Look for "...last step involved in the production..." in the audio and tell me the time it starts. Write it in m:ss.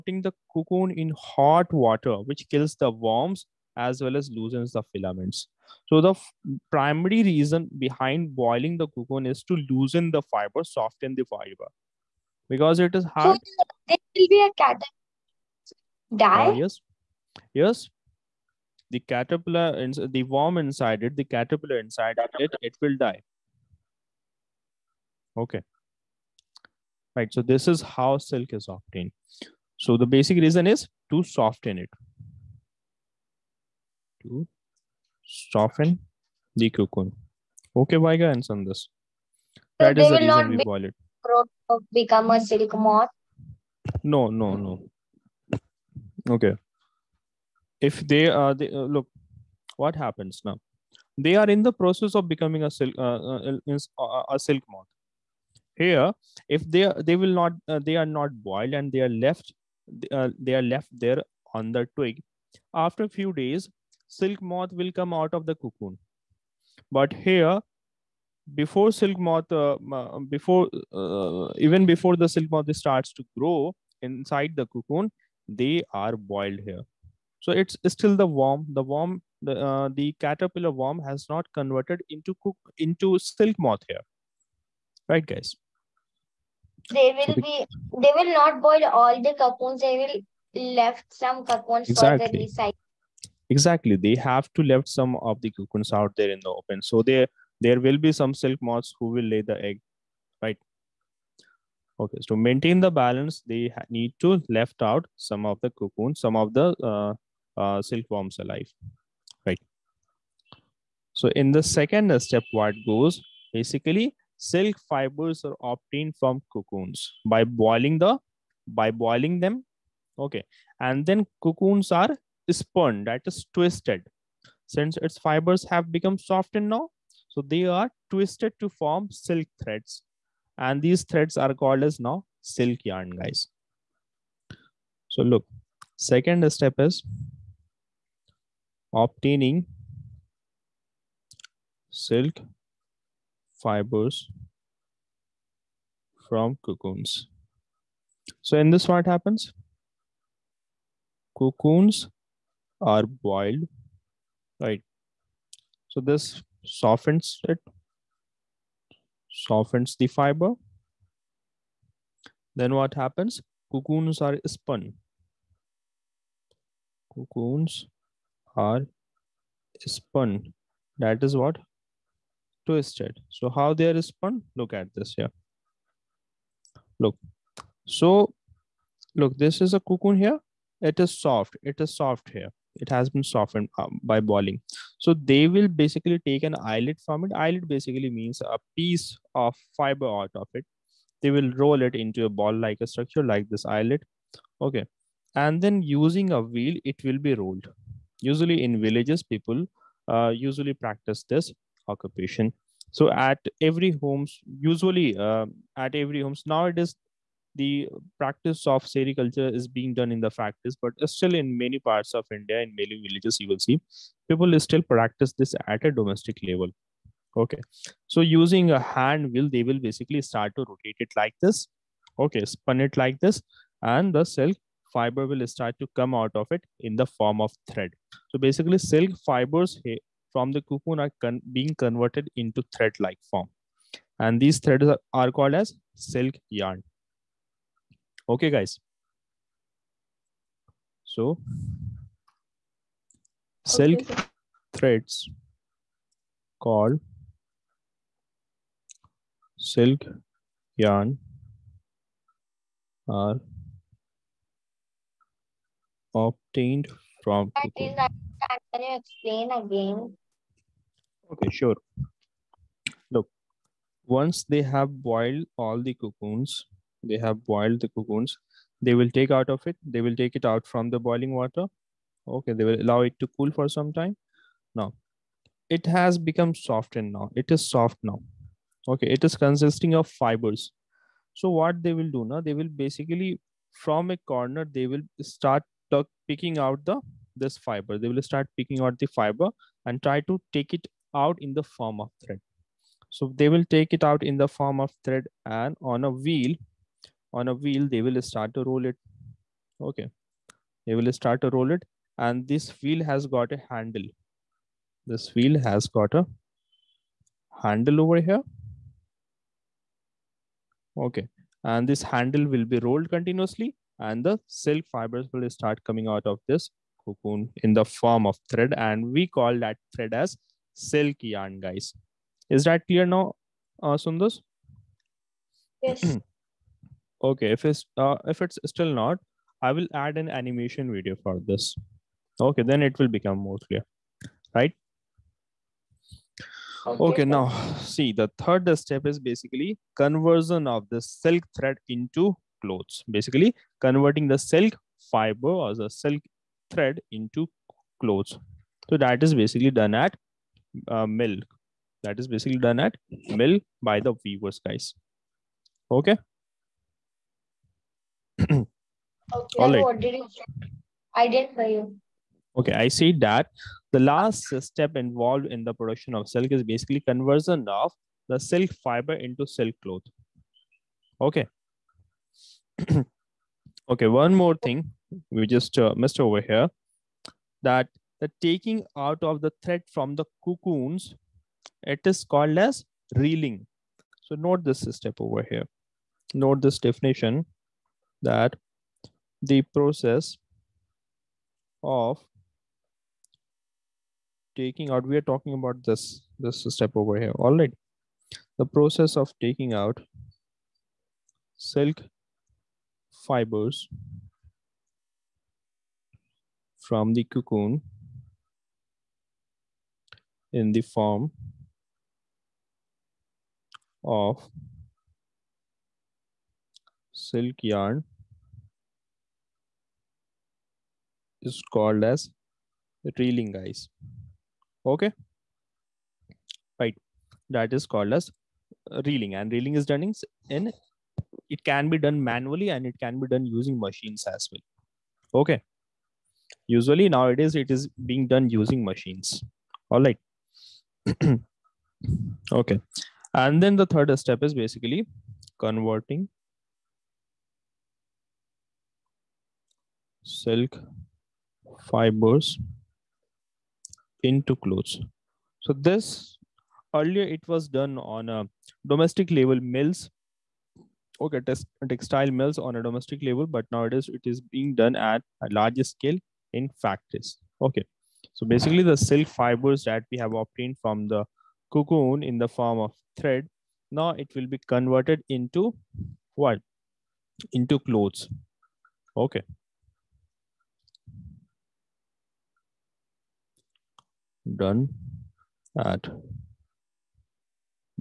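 6:04.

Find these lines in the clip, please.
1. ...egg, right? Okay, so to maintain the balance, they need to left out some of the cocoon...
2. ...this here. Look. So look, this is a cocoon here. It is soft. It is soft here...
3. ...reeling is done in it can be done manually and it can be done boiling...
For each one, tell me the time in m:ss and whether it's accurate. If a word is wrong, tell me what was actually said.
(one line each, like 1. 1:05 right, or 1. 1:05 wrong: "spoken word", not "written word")
1. 1:39 right
2. 2:54 right
3. 7:09 wrong: "using", not "boiling".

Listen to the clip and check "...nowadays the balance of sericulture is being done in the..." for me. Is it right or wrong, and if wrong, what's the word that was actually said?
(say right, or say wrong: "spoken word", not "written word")
wrong: "practice", not "balance".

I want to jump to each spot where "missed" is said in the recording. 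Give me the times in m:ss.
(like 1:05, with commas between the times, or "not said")
6:15.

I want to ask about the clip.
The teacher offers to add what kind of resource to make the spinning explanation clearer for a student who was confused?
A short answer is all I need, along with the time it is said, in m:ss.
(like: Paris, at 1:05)
animation video, at 5:30.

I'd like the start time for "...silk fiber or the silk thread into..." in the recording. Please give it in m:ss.
5:44.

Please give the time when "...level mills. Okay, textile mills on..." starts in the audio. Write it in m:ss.
7:39.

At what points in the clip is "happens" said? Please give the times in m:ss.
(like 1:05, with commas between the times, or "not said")
0:49, 2:29, 2:42.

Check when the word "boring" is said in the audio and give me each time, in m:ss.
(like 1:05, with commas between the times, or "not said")
not said.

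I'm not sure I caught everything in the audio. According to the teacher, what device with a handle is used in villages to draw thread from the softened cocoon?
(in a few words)
hand wheel.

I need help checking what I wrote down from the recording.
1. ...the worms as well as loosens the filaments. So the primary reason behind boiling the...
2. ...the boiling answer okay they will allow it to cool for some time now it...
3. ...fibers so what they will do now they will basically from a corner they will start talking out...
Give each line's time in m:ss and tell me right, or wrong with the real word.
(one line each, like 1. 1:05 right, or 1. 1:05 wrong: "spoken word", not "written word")
1. 0:02 right
2. 4:30 wrong: "water", not "answer"
3. 4:40 wrong: "picking", not "talking".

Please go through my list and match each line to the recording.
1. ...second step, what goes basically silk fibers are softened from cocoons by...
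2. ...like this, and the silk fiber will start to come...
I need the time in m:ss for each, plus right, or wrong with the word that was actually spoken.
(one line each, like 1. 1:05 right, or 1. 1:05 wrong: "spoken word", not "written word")
1. 1:51 wrong: "obtained", not "softened"
2. 3:42 right.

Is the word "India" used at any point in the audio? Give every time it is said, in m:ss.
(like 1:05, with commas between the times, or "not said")
3:32.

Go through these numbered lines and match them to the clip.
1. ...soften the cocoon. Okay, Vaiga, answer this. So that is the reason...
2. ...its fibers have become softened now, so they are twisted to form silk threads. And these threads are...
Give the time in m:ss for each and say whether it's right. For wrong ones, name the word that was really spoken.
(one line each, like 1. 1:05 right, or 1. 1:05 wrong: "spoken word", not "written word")
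1. 0:35 right
2. 2:04 right.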